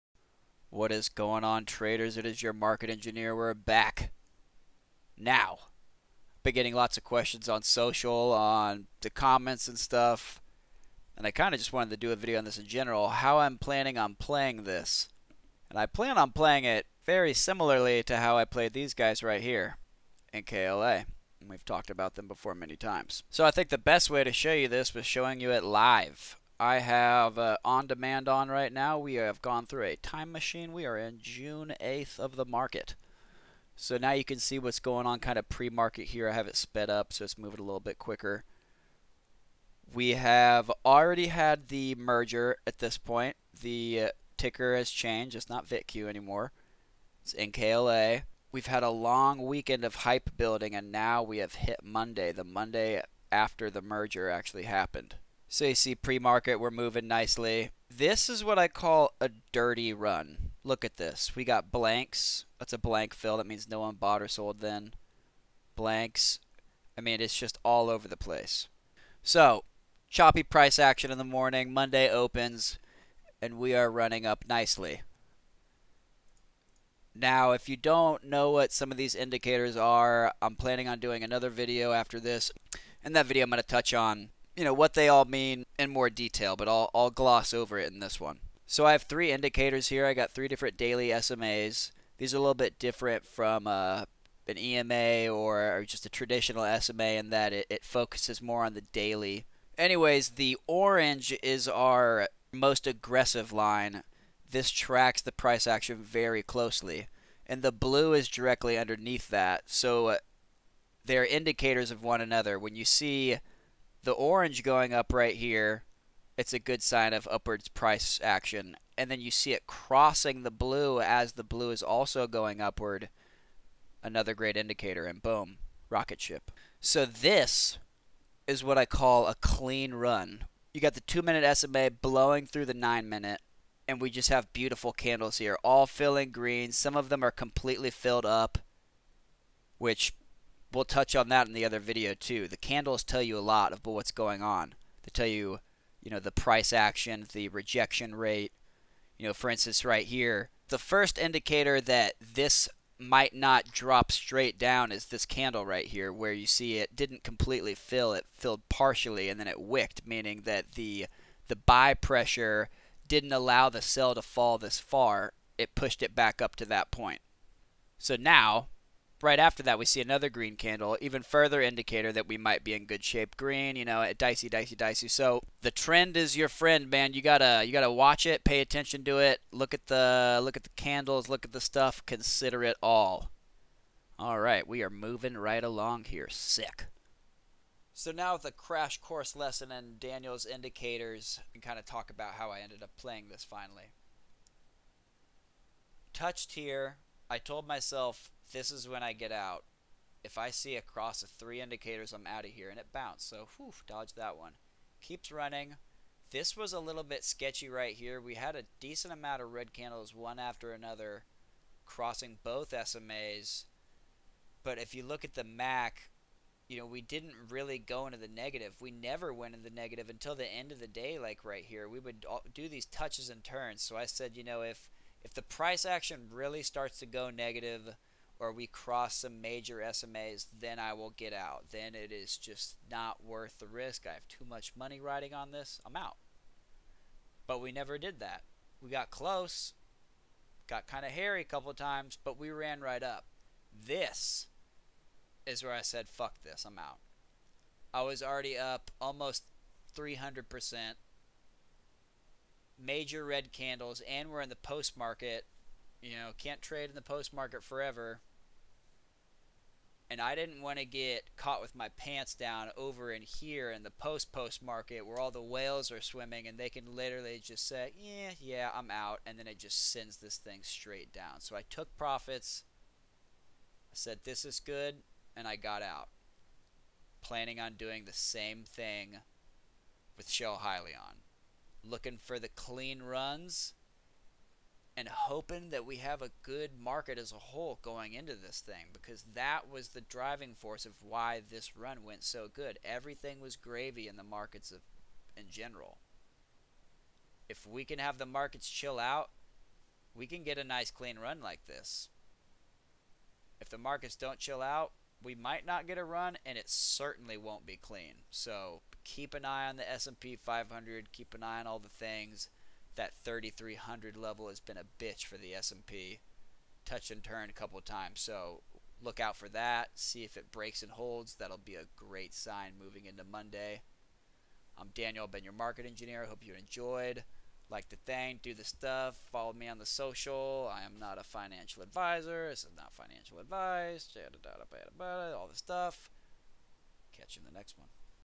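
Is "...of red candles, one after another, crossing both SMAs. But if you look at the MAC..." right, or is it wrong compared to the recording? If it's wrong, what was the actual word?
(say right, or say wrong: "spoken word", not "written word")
right.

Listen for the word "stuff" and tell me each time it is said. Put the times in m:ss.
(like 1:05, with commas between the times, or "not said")
0:09, 3:01, 5:28, 5:35.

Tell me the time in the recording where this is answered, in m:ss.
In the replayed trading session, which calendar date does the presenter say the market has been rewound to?
0:31.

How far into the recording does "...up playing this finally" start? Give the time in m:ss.
3:12.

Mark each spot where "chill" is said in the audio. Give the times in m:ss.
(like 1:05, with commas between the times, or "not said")
4:58, 5:04.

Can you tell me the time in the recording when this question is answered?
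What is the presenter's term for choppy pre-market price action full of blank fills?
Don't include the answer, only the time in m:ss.
0:59.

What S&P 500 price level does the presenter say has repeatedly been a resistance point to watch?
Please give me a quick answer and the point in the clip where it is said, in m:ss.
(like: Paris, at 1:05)
3300, at 5:13.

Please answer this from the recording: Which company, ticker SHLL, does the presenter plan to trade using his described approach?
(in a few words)
Hyliion.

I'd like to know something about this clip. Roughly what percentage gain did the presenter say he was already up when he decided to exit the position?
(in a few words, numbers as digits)
300%.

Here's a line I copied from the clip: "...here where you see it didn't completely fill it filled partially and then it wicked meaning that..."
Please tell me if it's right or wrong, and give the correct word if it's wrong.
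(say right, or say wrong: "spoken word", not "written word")
right.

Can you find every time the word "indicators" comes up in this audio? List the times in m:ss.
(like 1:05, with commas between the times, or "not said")
1:19, 1:29, 1:51, 2:04, 2:31, 2:51, 3:10, 3:21.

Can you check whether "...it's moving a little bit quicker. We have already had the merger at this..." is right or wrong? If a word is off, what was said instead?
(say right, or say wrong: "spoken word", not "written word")
right.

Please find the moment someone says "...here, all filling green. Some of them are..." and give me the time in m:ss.
2:15.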